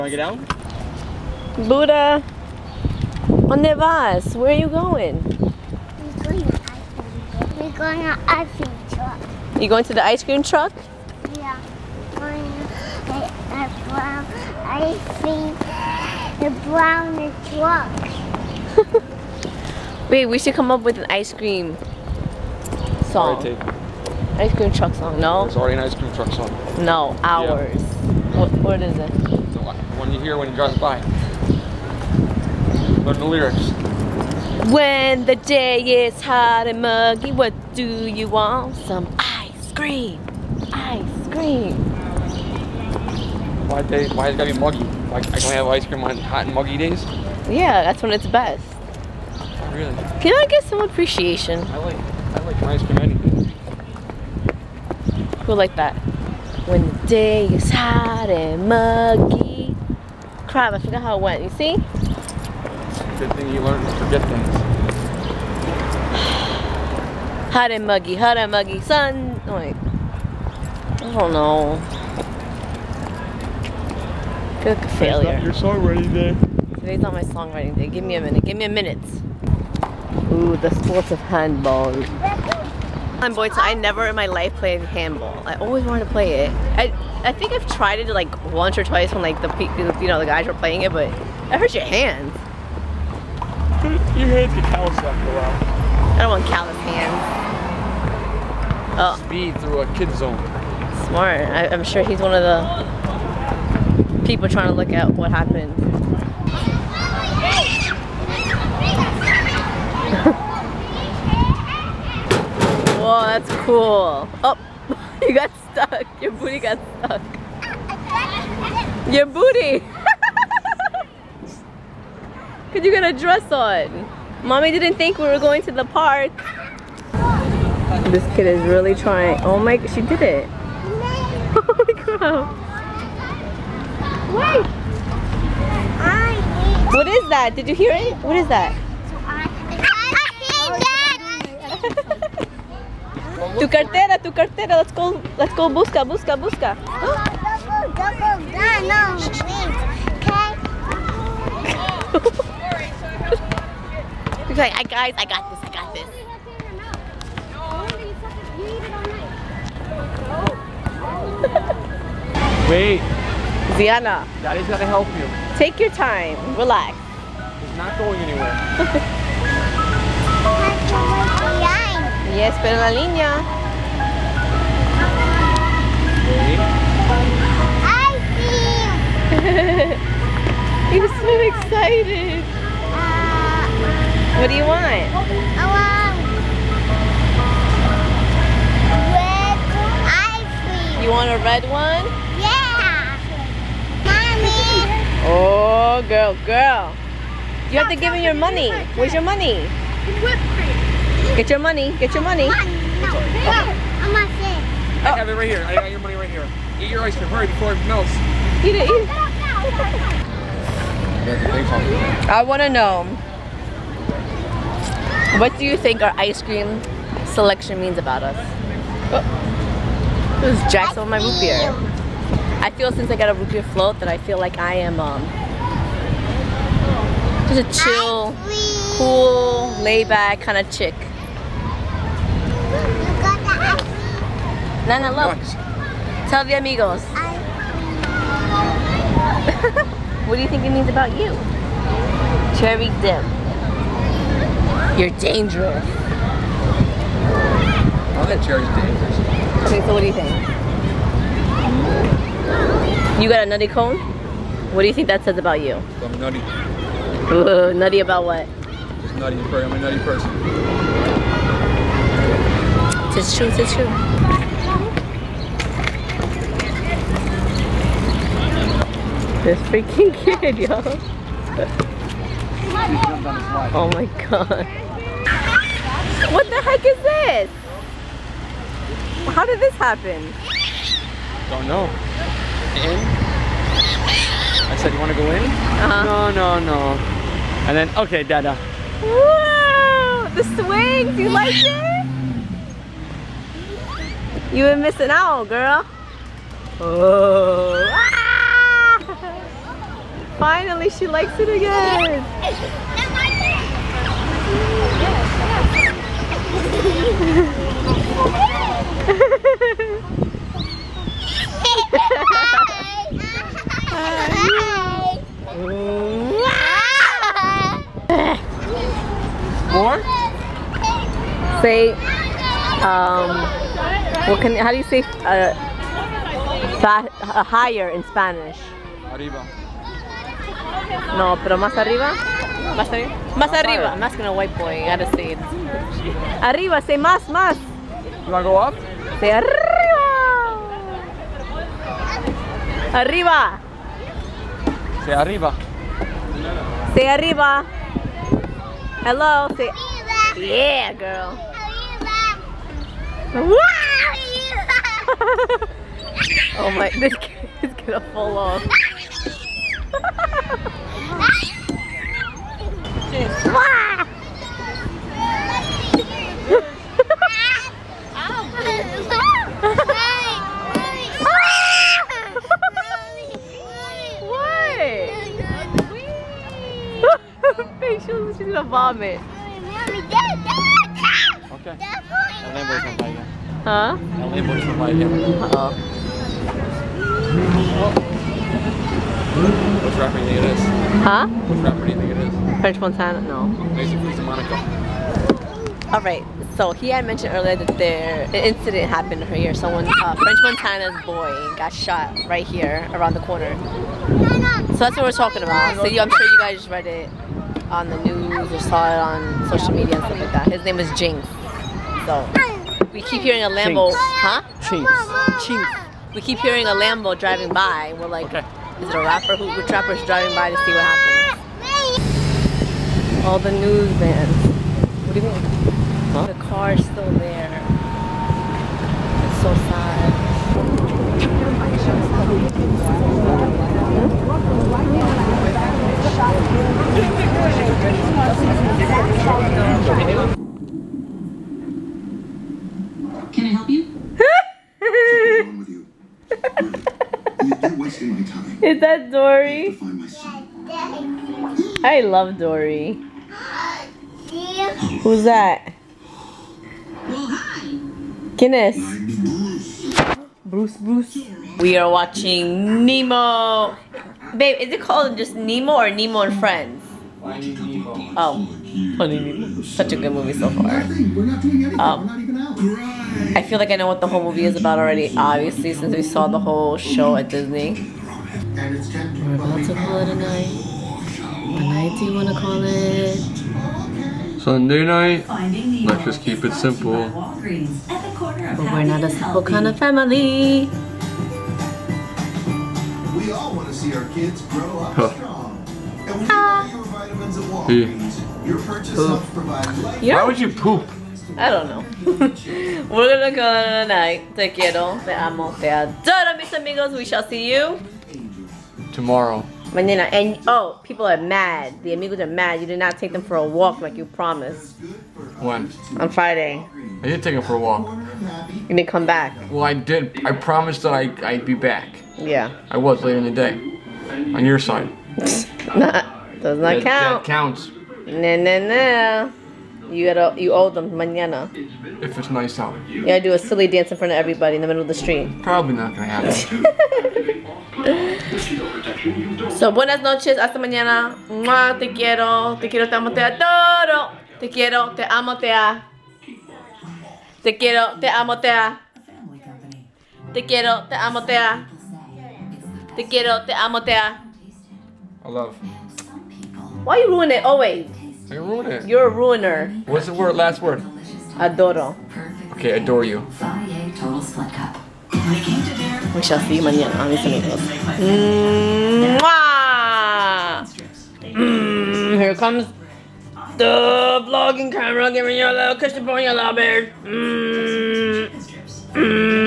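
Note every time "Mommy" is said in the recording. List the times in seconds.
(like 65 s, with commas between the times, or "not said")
124 s, 194 s.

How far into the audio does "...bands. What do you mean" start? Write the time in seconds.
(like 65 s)
423 s.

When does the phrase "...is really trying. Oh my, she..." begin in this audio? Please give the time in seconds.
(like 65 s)
128 s.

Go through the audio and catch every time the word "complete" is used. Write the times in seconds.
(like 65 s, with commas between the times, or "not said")
not said.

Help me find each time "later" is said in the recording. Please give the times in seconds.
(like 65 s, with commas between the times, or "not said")
523 s.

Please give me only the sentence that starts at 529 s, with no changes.
You gotta, you owe them mañana.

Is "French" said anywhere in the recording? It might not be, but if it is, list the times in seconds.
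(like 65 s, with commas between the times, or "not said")
392 s, 400 s.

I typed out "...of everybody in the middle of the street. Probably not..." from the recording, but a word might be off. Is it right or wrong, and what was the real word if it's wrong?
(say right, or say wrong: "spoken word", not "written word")
right.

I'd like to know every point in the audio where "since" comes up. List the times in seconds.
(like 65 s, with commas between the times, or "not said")
222 s, 475 s.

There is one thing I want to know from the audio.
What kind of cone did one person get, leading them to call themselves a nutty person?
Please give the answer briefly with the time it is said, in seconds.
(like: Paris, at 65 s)
Nutty cone, at 253 s.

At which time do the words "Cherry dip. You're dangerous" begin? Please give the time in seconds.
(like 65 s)
242 s.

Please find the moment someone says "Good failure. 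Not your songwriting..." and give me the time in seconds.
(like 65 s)
74 s.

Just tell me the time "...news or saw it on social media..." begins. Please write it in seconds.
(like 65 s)
408 s.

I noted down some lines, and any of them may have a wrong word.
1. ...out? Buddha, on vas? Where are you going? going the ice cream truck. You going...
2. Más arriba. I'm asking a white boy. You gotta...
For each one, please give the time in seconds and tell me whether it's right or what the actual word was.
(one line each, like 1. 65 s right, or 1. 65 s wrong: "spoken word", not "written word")
1. 0 s right
2. 333 s right.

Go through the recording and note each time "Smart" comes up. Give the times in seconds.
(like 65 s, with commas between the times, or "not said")
101 s.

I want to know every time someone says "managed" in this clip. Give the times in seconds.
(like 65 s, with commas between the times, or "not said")
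not said.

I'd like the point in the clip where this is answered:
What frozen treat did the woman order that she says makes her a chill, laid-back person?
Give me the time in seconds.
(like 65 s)
223 s.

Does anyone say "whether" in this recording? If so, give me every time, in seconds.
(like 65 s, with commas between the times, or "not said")
not said.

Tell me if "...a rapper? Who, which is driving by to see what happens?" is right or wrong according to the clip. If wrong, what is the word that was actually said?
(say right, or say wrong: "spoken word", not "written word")
right.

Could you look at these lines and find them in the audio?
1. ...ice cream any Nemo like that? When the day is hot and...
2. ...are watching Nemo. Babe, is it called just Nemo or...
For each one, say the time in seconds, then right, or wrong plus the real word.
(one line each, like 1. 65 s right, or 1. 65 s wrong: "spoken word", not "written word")
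1. 52 s wrong: "Who", not "Nemo"
2. 461 s right.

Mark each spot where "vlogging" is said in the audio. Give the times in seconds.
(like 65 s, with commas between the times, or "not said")
574 s.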